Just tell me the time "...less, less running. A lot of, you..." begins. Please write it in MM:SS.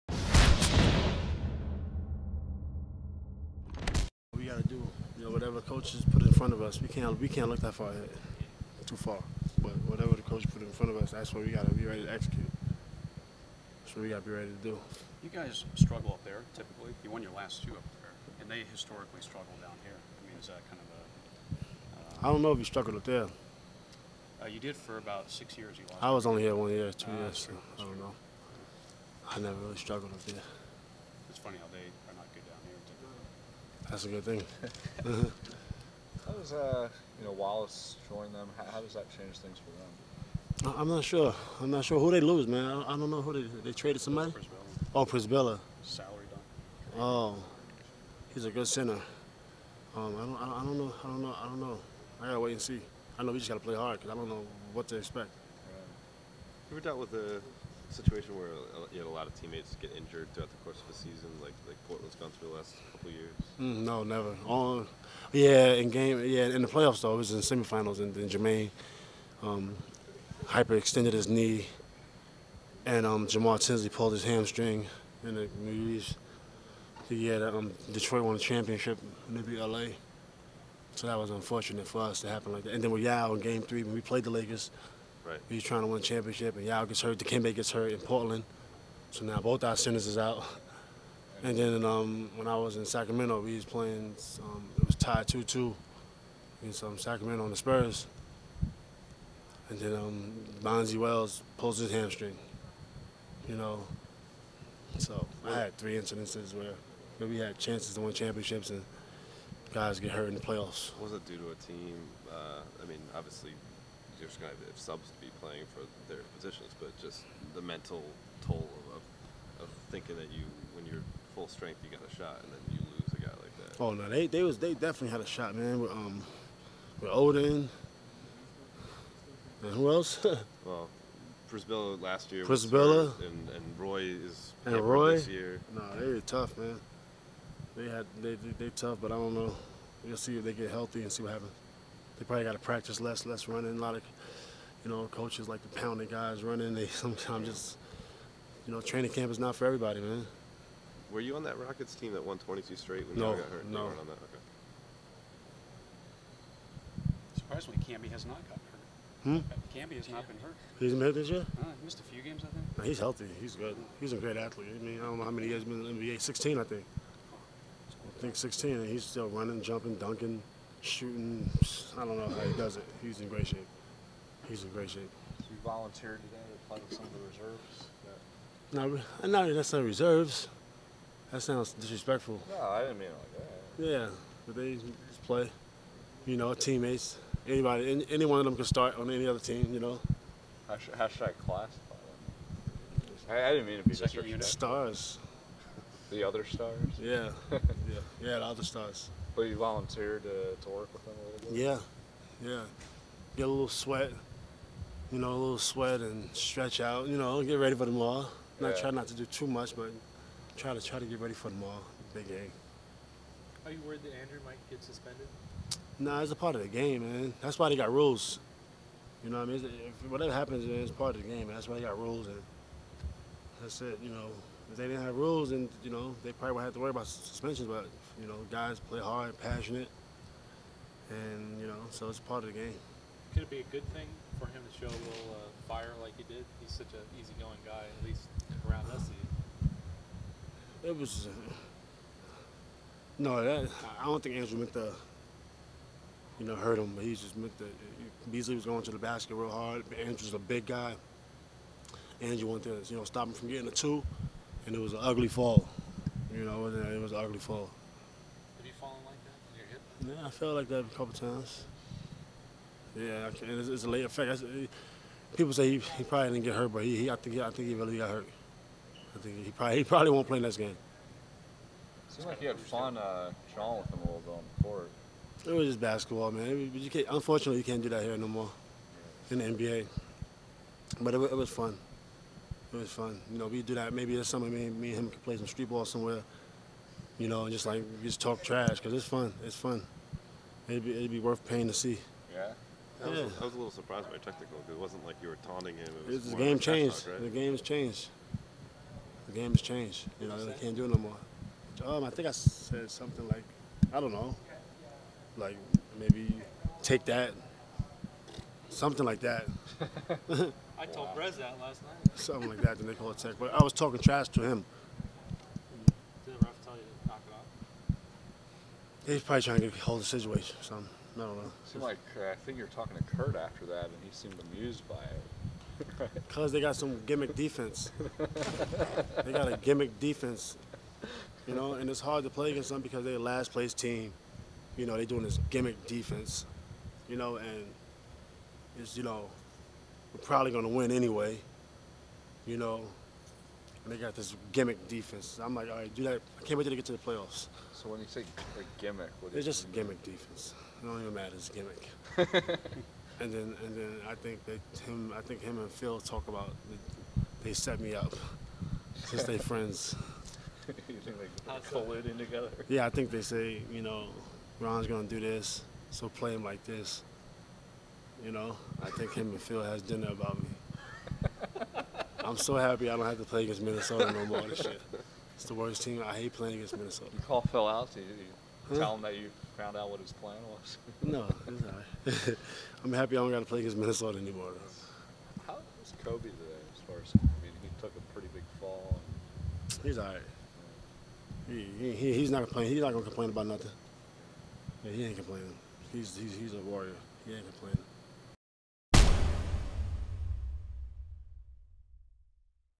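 02:23.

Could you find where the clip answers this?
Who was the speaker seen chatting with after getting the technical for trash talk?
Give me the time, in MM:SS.
05:23.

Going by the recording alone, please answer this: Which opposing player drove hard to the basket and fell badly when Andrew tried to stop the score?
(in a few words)
Beasley.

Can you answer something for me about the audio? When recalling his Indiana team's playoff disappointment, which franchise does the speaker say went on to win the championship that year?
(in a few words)
Detroit.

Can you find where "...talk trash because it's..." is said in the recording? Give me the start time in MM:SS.
04:48.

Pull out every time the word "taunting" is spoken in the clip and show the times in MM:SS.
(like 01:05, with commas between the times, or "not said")
04:55.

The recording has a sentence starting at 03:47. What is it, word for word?
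But you know, guys play hard, passionate, and you know, so it's part of the game.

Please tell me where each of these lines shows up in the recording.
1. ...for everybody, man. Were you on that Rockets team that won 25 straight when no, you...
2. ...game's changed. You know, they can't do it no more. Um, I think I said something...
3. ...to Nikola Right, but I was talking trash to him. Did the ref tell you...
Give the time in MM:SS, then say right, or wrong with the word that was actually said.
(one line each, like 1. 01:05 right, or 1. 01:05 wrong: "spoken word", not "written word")
1. 02:29 wrong: "22", not "25"
2. 04:59 right
3. 05:12 wrong: "Tech", not "Right".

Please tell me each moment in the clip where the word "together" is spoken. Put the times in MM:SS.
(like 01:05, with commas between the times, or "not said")
06:02.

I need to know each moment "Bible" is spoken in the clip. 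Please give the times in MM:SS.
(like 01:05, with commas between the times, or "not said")
not said.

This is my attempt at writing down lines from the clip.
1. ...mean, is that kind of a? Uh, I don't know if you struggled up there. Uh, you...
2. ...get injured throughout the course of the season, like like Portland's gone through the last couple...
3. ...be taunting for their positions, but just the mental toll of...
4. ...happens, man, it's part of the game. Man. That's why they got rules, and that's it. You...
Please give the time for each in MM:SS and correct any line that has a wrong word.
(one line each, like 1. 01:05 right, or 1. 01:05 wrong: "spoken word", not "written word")
1. 00:20 right
2. 00:59 right
3. 01:55 wrong: "playing", not "taunting"
4. 03:40 right.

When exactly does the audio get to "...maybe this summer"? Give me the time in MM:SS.
04:43.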